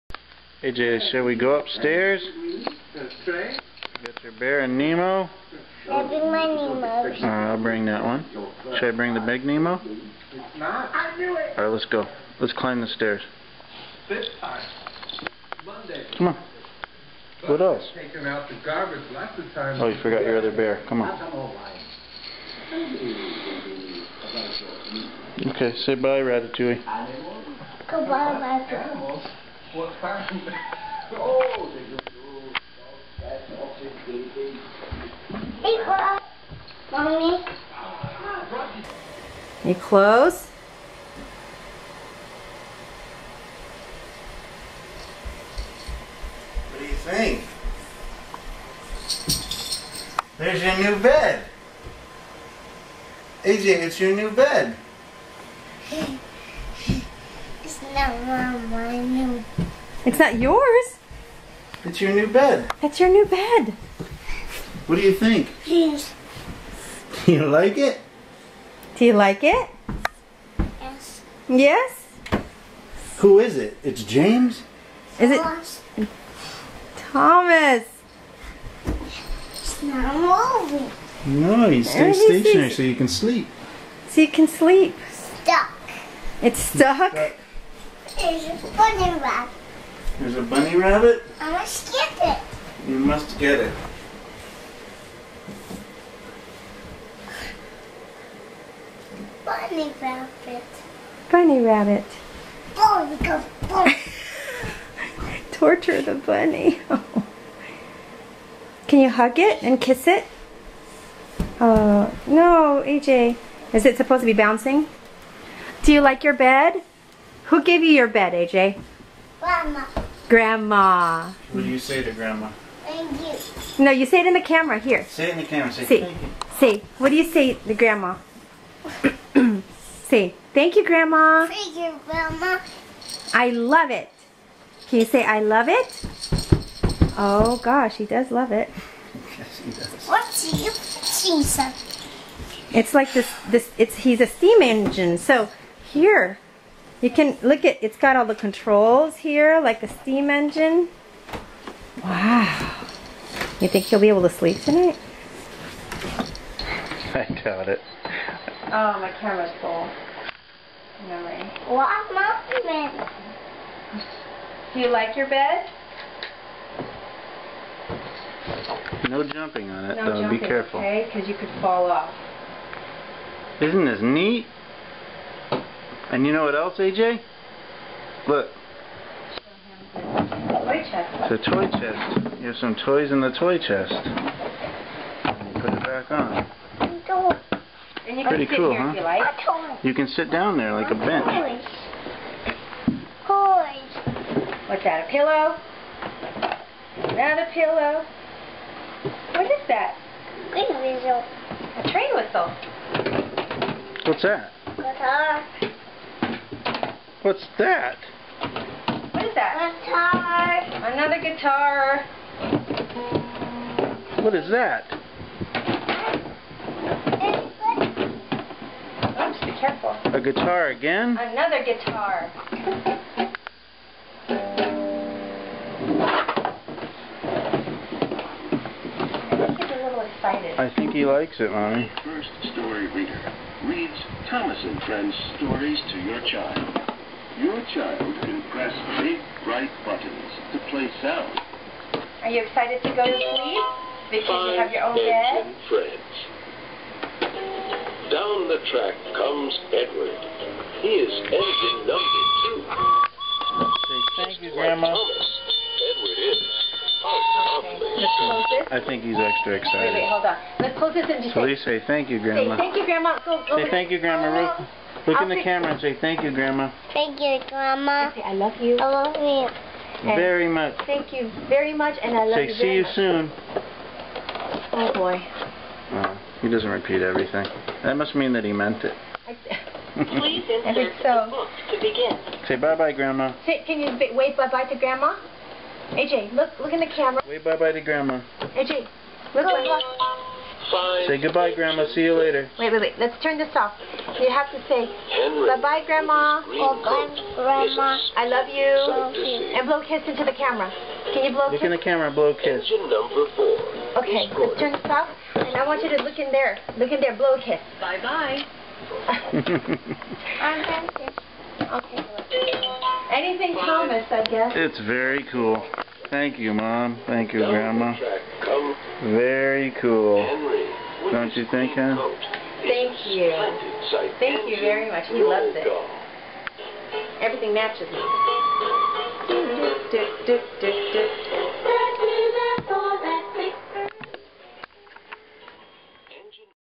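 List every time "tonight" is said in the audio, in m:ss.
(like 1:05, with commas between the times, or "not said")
2:34.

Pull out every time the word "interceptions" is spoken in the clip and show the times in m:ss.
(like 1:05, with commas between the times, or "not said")
not said.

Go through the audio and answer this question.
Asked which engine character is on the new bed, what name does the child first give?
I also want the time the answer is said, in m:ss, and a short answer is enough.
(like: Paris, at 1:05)
James, at 1:13.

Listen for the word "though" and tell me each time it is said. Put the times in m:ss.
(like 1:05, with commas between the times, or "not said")
2:50.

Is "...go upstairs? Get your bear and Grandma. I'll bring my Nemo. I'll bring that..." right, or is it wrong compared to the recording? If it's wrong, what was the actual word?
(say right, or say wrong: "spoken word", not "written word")
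wrong: "Nemo", not "Grandma".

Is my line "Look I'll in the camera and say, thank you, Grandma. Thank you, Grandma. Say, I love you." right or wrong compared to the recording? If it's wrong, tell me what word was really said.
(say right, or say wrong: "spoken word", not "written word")
right.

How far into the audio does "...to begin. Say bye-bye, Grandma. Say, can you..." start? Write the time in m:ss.
4:41.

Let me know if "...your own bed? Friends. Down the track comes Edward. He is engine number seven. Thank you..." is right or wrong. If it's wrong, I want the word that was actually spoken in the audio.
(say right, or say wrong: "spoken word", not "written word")
wrong: "two", not "seven".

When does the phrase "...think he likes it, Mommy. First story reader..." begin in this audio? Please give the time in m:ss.
3:50.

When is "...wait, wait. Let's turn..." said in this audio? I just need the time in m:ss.
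4:52.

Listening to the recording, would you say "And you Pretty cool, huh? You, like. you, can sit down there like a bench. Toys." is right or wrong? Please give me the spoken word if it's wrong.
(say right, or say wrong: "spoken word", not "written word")
right.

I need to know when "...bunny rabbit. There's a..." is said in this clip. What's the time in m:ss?
1:28.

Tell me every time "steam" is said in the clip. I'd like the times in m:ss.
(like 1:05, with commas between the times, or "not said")
2:24, 2:29.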